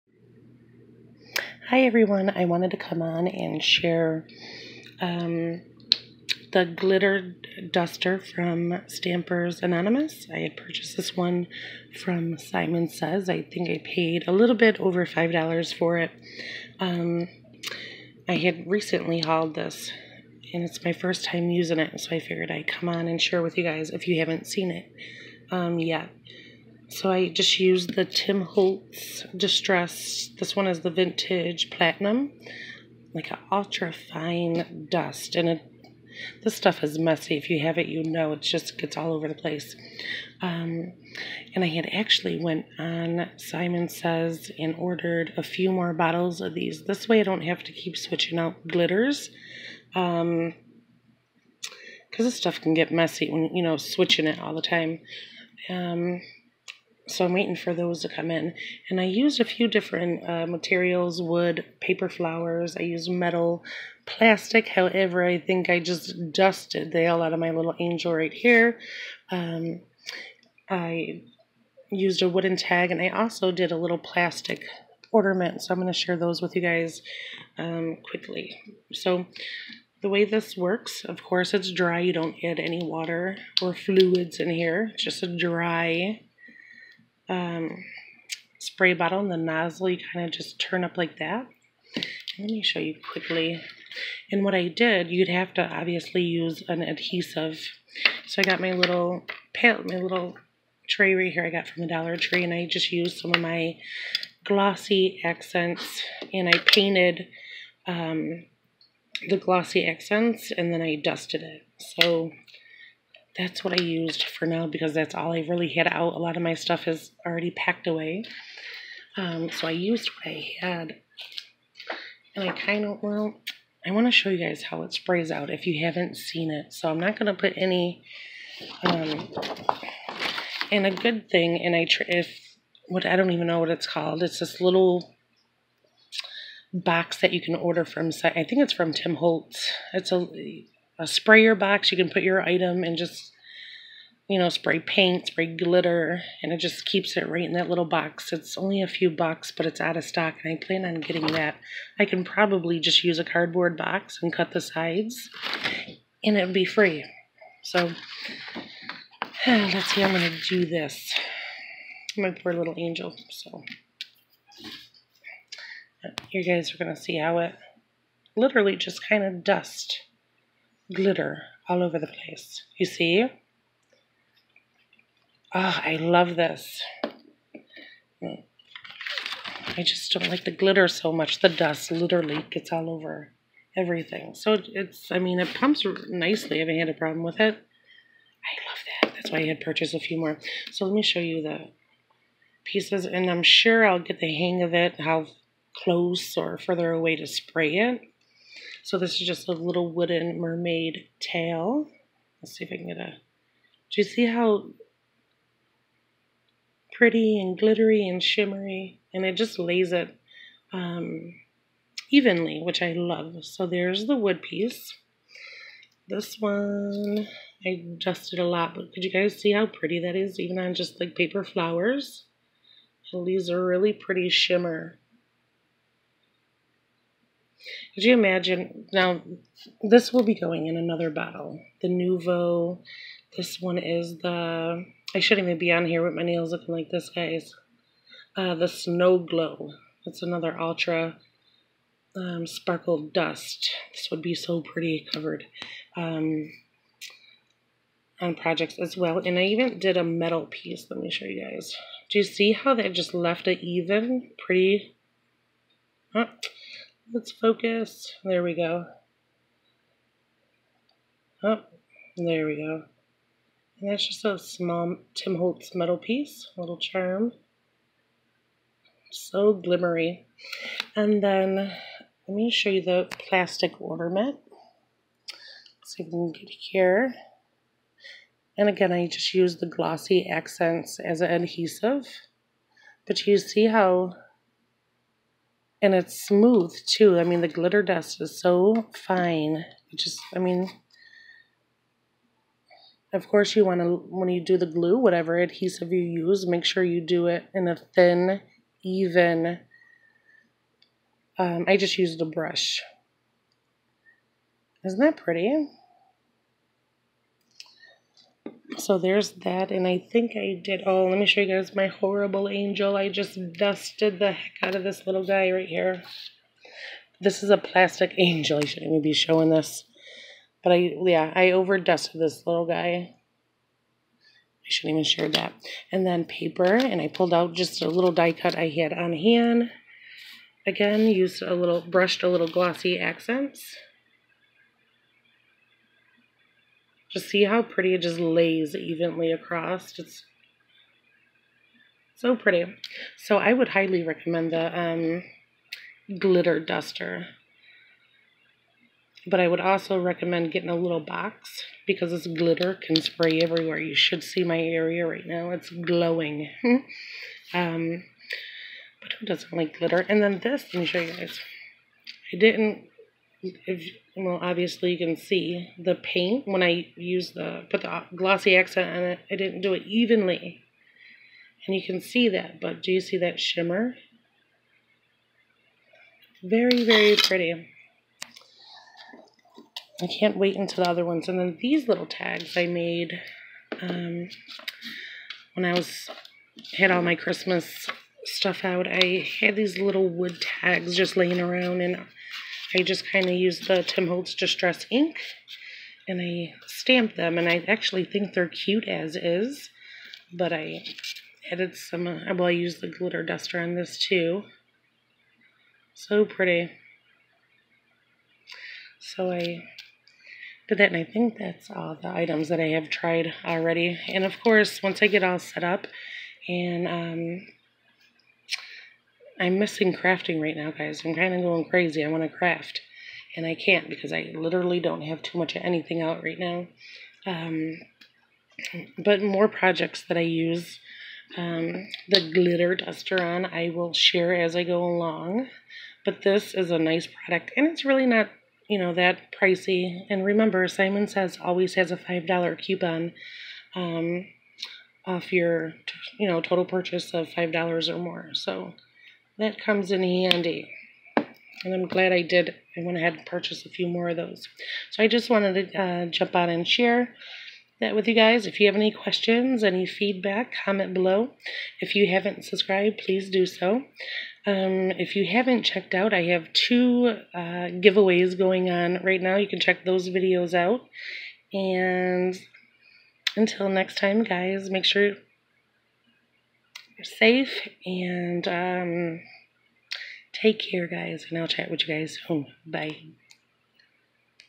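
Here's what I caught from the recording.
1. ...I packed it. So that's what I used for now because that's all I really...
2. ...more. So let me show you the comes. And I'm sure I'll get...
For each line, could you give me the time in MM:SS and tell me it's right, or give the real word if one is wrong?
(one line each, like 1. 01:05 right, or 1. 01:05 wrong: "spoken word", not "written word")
1. 01:50 wrong: "dusted", not "packed"
2. 03:10 wrong: "pieces", not "comes".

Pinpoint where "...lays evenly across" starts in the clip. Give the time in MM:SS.
05:38.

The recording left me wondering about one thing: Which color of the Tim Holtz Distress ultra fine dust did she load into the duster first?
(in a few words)
Vintage Platinum.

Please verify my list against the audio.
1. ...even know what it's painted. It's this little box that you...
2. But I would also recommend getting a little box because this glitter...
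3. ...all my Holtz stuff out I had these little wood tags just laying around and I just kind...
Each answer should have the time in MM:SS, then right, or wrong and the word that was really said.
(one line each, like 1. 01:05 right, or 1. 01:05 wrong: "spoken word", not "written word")
1. 02:13 wrong: "called", not "painted"
2. 05:49 right
3. 06:26 wrong: "Christmas", not "Holtz".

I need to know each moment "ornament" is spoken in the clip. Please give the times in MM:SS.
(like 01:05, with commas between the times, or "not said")
01:15, 04:33.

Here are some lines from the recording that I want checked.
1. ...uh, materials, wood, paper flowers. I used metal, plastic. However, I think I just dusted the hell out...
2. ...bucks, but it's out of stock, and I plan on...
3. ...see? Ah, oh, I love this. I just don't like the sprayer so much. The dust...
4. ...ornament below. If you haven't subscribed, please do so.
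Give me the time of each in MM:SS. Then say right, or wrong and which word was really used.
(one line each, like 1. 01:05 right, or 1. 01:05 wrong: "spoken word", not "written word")
1. 01:00 right
2. 02:29 right
3. 02:52 wrong: "glitter", not "sprayer"
4. 07:40 wrong: "comment", not "ornament".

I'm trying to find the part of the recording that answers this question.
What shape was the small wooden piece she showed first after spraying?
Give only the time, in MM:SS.
03:20.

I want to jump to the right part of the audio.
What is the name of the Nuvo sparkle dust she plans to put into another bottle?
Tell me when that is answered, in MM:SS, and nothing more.
03:58.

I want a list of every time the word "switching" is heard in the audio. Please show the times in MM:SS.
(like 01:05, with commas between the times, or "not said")
00:47, 00:53.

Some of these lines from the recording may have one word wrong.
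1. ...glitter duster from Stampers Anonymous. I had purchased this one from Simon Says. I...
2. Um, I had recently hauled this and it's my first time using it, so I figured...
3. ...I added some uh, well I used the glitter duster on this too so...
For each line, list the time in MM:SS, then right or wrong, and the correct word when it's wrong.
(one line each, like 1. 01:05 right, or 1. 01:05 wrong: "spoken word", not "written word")
1. 00:06 right
2. 00:16 right
3. 06:40 right.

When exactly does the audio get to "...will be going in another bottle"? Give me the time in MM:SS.
03:50.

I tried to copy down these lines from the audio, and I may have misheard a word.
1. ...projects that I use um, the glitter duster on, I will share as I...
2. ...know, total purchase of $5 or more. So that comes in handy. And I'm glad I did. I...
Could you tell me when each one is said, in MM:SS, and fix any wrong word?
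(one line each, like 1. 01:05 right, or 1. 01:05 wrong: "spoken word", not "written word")
1. 07:09 right
2. 07:26 right.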